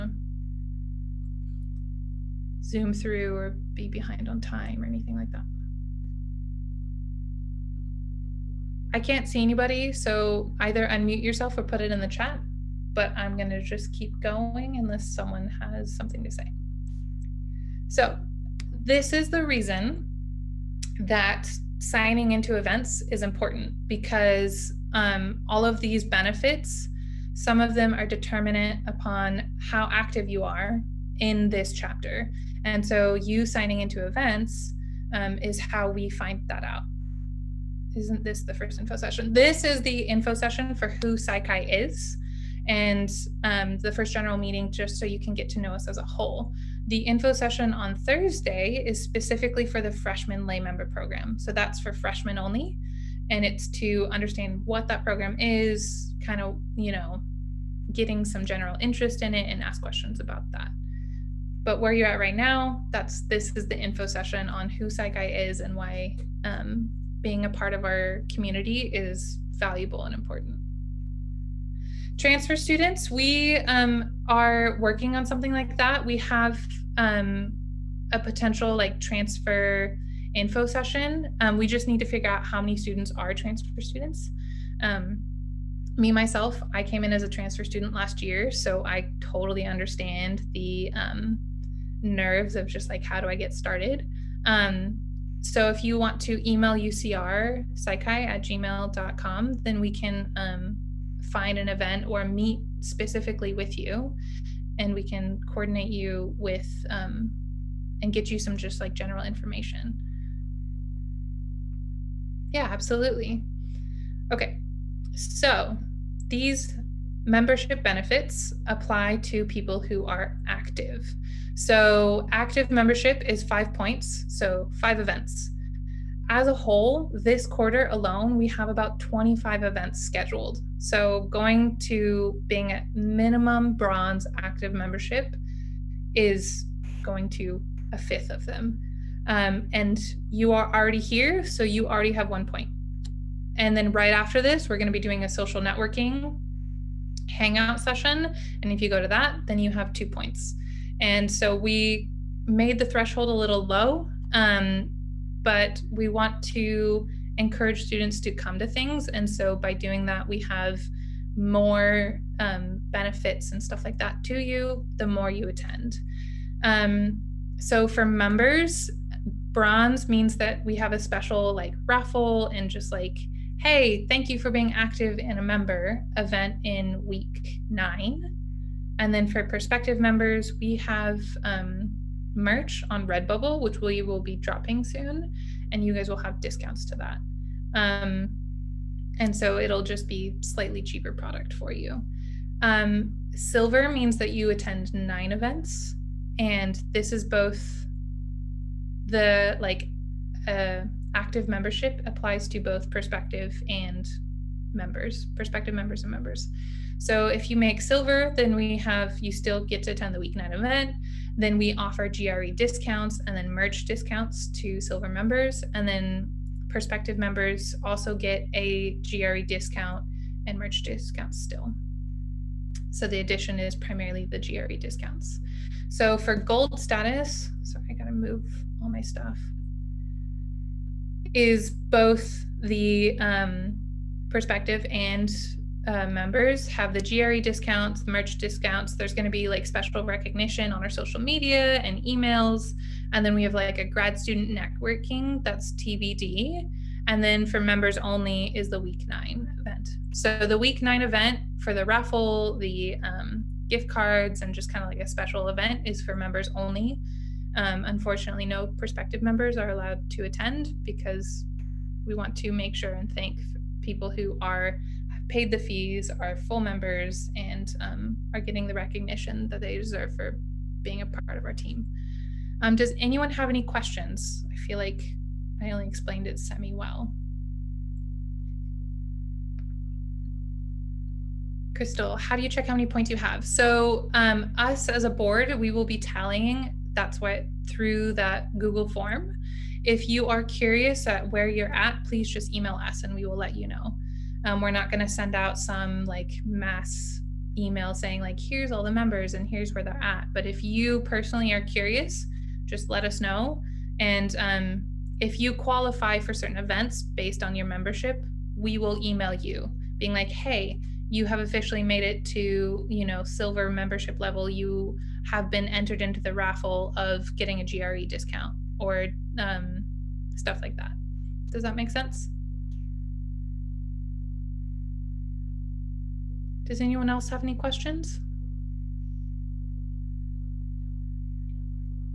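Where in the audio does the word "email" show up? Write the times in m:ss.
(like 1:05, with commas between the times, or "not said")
1:36, 4:02, 4:52, 4:57, 5:09.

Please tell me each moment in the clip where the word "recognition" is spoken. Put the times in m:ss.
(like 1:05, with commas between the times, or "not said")
4:00, 4:28.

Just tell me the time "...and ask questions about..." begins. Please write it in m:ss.
0:59.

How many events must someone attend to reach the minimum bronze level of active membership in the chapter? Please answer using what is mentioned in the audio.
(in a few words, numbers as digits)
5.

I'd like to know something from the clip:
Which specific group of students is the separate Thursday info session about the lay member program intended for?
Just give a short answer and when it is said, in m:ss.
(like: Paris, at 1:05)
Freshmen only, at 0:51.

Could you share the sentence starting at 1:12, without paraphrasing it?
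Transfer students, we um, are working on something like that.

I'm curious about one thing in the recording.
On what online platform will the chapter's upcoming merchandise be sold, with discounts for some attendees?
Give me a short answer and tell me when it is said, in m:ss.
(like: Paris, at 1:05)
Redbubble, at 3:03.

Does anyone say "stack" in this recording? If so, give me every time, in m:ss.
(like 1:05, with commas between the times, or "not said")
not said.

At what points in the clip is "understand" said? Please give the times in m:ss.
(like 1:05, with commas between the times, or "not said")
0:54, 1:29.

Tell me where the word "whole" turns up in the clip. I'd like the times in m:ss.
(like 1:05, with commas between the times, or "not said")
0:46, 2:06.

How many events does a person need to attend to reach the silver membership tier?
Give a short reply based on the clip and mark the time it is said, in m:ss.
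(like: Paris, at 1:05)
9, at 3:14.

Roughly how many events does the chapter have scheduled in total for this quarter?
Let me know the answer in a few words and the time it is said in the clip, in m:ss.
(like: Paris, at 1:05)
25, at 2:08.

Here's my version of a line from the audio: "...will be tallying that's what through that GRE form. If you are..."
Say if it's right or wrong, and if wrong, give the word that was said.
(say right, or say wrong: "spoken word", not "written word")
wrong: "Google", not "GRE".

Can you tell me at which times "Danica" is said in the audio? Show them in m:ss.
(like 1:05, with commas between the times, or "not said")
not said.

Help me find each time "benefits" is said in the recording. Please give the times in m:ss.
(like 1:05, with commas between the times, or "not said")
0:26, 1:57, 2:42.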